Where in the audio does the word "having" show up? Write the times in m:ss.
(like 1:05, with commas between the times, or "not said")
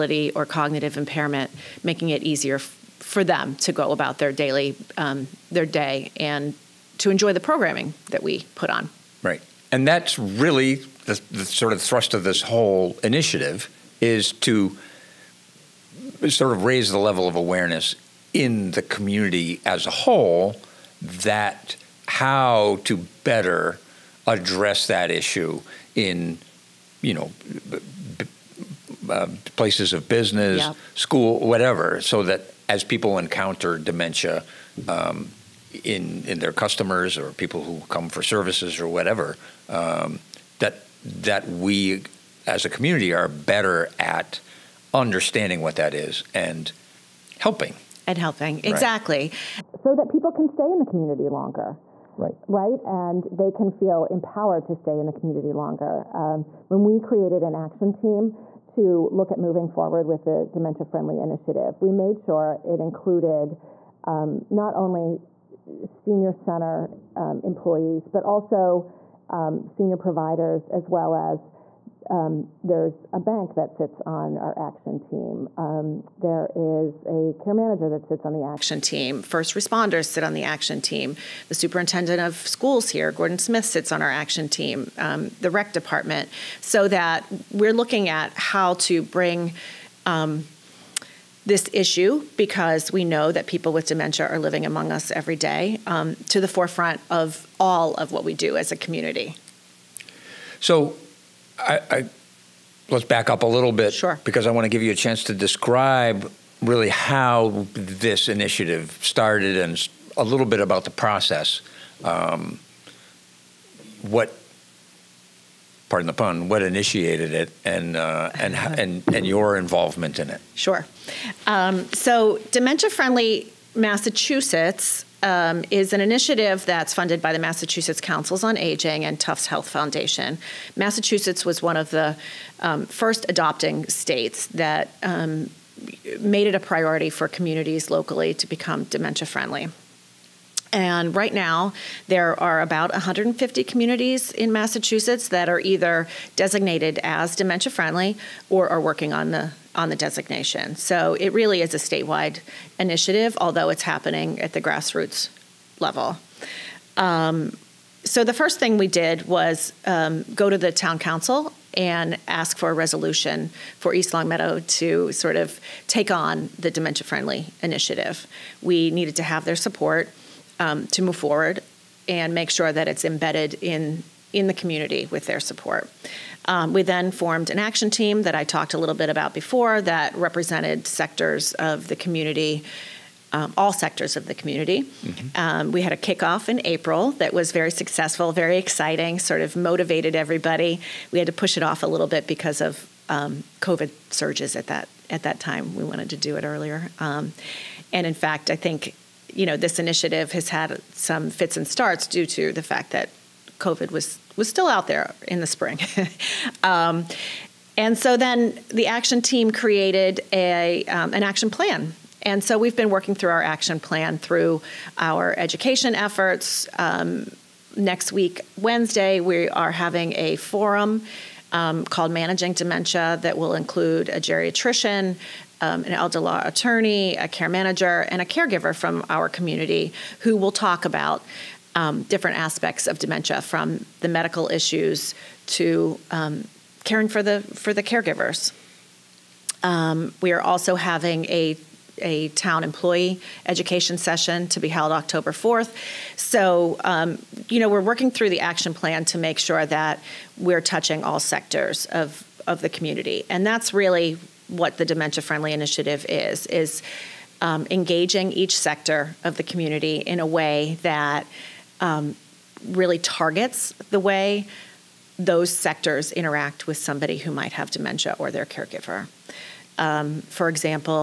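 3:39, 4:00.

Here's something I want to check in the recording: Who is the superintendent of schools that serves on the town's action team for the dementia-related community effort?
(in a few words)
Gordon Smith.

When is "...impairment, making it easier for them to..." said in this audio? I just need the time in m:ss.
0:00.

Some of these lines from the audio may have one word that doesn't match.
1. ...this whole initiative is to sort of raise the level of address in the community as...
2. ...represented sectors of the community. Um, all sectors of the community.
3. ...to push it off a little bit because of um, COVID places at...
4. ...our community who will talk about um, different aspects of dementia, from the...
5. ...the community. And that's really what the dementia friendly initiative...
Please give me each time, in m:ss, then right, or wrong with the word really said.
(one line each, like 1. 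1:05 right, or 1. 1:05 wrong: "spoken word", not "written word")
1. 0:12 wrong: "awareness", not "address"
2. 3:00 right
3. 3:11 wrong: "surges", not "places"
4. 3:49 right
5. 4:12 right.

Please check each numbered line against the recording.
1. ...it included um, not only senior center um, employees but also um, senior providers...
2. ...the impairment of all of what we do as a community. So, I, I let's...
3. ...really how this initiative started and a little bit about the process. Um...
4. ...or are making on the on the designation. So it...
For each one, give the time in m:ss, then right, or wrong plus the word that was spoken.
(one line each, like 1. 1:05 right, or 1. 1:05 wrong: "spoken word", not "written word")
1. 1:02 right
2. 1:36 wrong: "forefront", not "impairment"
3. 1:46 right
4. 2:28 wrong: "working", not "making".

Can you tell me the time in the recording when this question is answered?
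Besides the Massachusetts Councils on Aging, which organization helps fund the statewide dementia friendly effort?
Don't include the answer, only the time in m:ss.
2:09.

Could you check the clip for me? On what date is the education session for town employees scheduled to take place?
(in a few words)
October 4th.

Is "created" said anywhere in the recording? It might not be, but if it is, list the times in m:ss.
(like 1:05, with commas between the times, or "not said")
0:56, 3:29.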